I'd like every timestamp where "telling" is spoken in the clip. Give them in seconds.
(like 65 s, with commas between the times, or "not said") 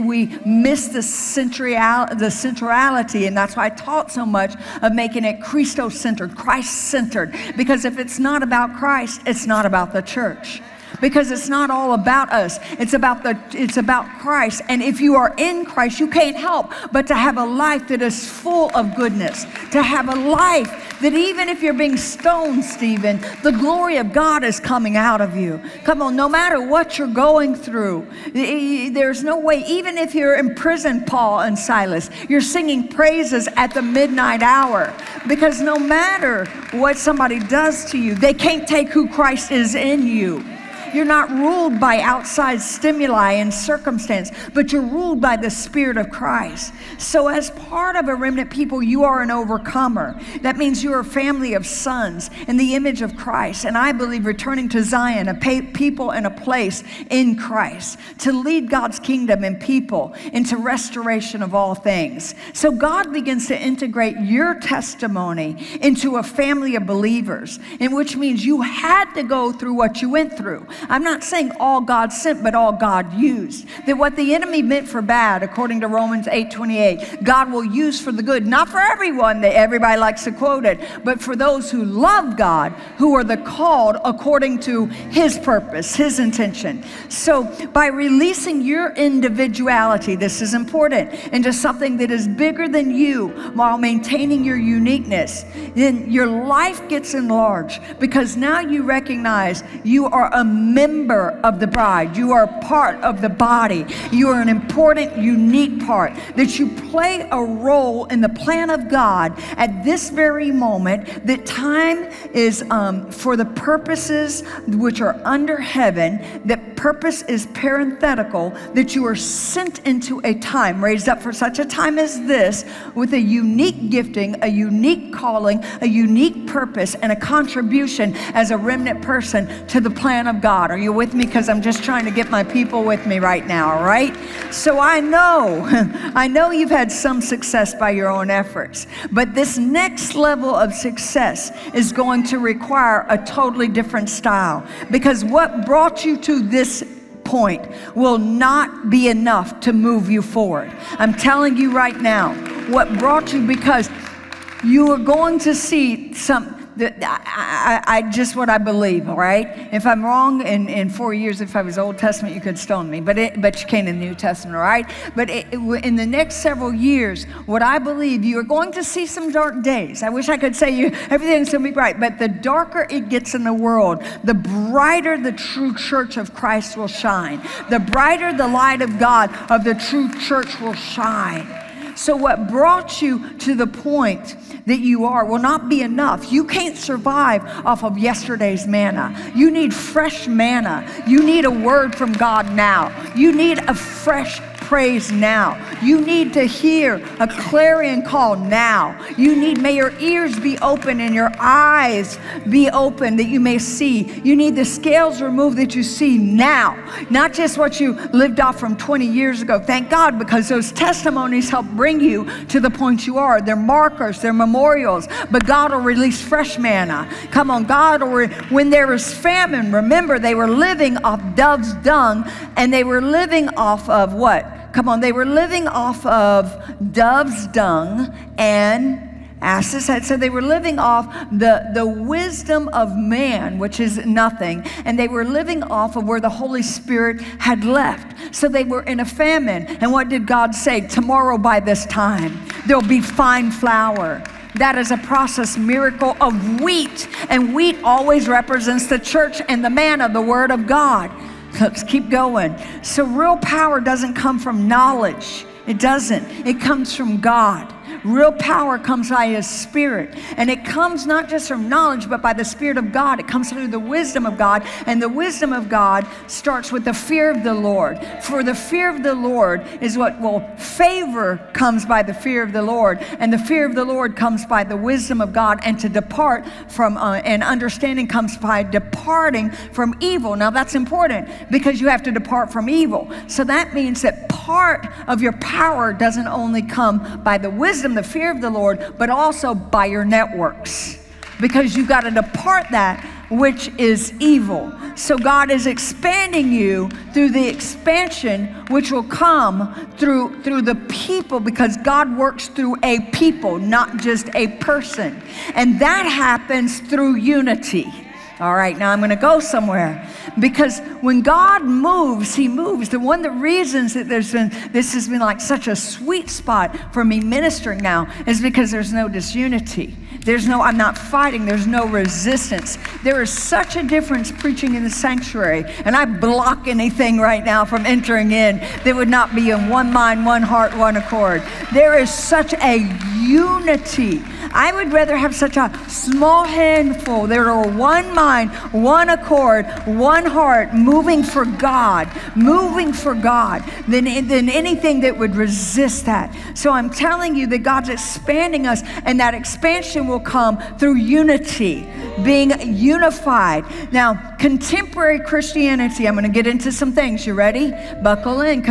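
151 s, 346 s.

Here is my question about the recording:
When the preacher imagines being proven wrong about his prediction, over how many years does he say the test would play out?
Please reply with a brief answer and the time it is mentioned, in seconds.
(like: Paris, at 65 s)
4, at 160 s.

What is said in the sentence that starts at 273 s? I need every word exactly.
And the fear of the Lord comes by the wisdom of God.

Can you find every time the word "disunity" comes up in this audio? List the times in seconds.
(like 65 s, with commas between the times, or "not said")
319 s.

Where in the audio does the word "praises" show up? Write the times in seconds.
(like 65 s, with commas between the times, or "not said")
32 s, 194 s.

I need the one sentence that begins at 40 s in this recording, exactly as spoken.
You're not ruled by outside stimuli and circumstance, but you're ruled by the Spirit of Christ.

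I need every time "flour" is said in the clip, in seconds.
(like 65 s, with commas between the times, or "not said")
243 s.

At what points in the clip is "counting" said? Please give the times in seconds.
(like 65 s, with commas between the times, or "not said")
not said.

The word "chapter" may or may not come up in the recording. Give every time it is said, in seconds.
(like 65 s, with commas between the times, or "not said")
not said.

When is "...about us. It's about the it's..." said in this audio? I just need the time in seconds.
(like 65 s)
11 s.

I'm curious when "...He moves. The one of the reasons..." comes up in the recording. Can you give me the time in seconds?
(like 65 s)
312 s.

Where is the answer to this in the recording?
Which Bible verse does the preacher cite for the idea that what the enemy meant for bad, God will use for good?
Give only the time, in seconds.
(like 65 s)
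75 s.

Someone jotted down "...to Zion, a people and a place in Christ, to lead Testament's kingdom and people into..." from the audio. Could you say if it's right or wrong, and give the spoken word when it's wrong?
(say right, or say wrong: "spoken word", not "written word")
wrong: "God", not "Testament".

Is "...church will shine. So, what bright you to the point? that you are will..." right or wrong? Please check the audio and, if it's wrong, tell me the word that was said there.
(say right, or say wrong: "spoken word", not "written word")
wrong: "brought", not "bright".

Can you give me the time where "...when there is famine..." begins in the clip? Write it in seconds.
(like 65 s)
218 s.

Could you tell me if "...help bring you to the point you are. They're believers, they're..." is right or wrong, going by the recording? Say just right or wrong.
wrong.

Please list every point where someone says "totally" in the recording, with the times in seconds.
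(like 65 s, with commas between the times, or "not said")
143 s.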